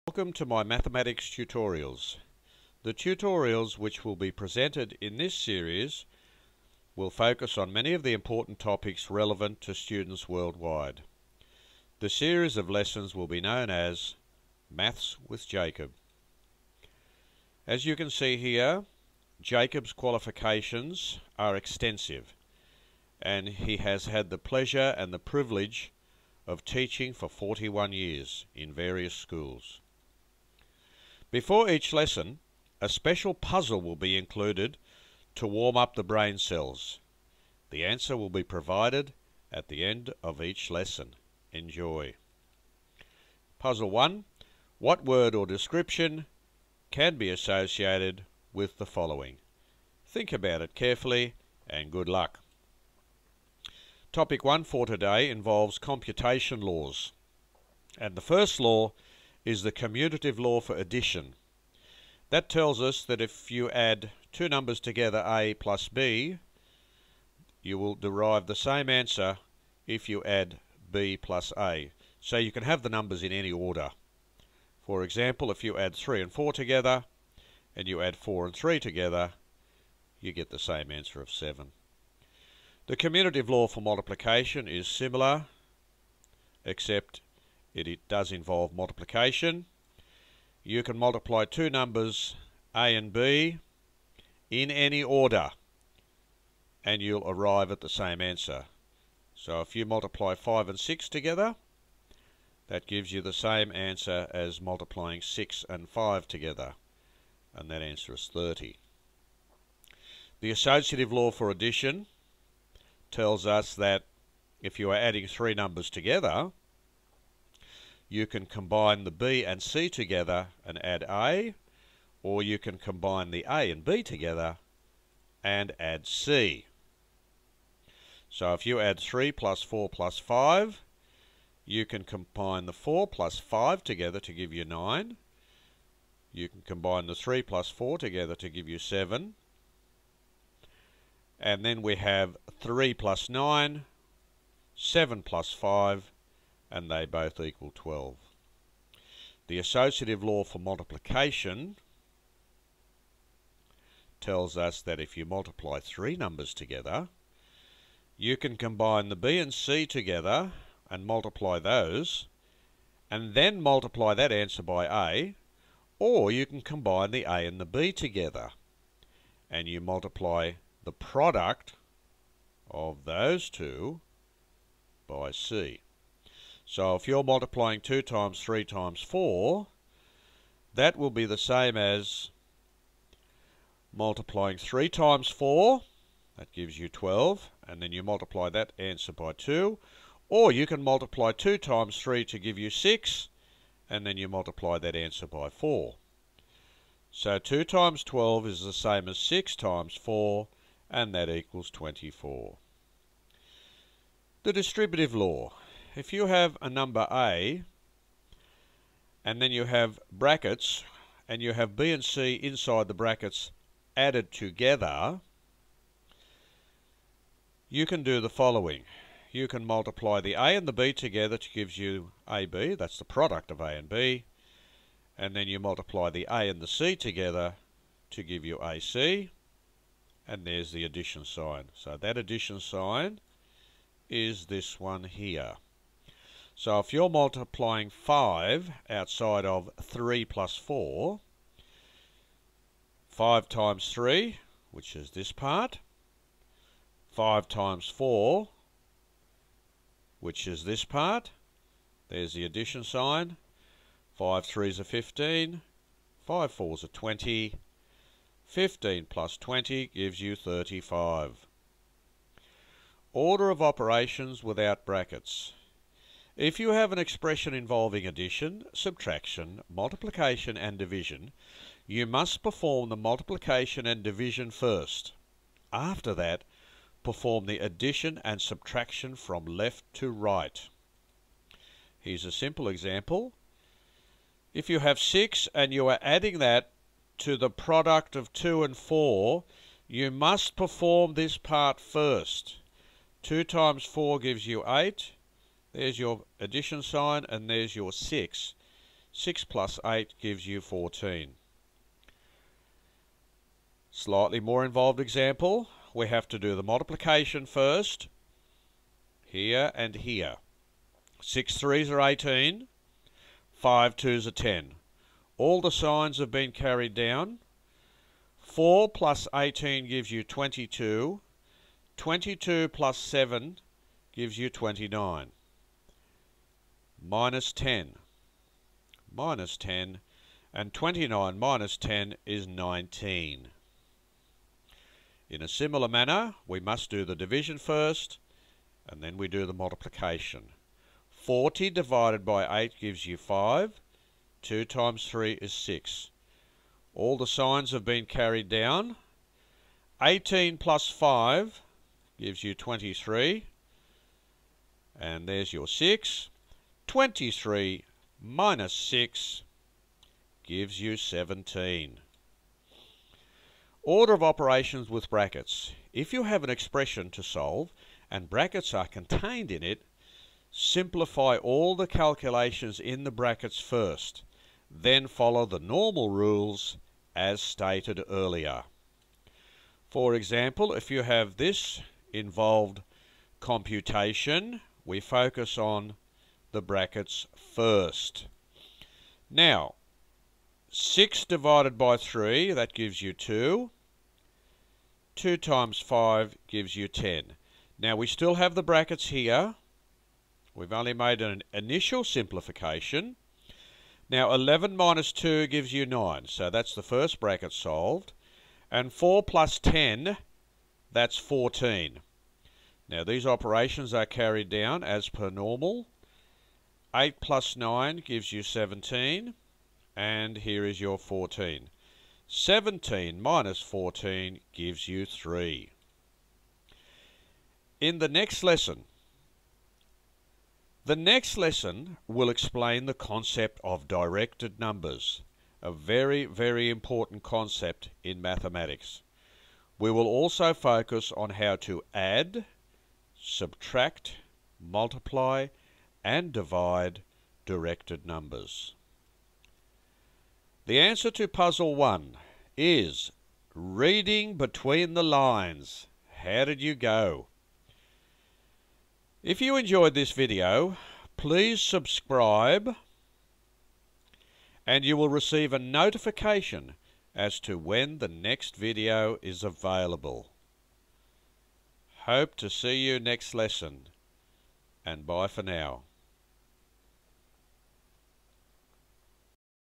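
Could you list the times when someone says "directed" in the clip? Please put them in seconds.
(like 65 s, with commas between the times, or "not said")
433 s, 447 s.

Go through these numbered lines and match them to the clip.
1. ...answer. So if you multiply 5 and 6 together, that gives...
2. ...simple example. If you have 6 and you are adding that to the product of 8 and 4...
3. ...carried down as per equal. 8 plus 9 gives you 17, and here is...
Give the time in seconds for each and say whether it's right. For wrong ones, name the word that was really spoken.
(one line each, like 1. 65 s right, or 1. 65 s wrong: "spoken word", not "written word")
1. 98 s right
2. 282 s wrong: "2", not "8"
3. 414 s wrong: "normal", not "equal".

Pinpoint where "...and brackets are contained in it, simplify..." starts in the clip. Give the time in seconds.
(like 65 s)
368 s.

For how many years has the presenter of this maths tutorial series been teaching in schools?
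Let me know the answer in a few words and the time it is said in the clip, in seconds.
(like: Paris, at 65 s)
41, at 27 s.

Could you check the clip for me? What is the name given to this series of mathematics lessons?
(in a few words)
Maths with Jacob.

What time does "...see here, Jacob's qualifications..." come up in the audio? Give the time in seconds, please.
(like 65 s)
18 s.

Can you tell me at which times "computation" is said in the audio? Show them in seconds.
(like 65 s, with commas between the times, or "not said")
55 s, 383 s.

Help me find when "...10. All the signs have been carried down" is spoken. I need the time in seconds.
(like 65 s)
314 s.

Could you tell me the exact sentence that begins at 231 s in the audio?
So that addition sign is this one here.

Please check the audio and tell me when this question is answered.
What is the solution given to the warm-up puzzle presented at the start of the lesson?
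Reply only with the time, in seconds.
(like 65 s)
453 s.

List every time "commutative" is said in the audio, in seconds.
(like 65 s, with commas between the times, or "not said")
59 s, 82 s.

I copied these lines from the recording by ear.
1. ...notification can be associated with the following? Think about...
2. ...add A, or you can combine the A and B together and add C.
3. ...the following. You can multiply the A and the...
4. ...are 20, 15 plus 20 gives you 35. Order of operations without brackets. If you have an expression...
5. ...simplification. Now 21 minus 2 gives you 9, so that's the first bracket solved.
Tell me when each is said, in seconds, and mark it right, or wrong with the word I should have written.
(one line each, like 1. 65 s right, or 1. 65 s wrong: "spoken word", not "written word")
1. 45 s wrong: "description", not "notification"
2. 120 s right
3. 218 s right
4. 256 s right
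5. 402 s wrong: "11", not "21".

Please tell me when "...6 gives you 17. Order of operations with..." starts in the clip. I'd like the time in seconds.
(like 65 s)
358 s.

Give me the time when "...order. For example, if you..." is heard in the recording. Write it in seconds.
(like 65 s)
73 s.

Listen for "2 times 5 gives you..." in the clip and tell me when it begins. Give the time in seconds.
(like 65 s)
395 s.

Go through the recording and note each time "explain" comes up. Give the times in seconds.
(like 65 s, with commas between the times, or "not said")
432 s.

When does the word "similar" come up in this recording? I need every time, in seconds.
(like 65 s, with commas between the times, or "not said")
84 s, 335 s.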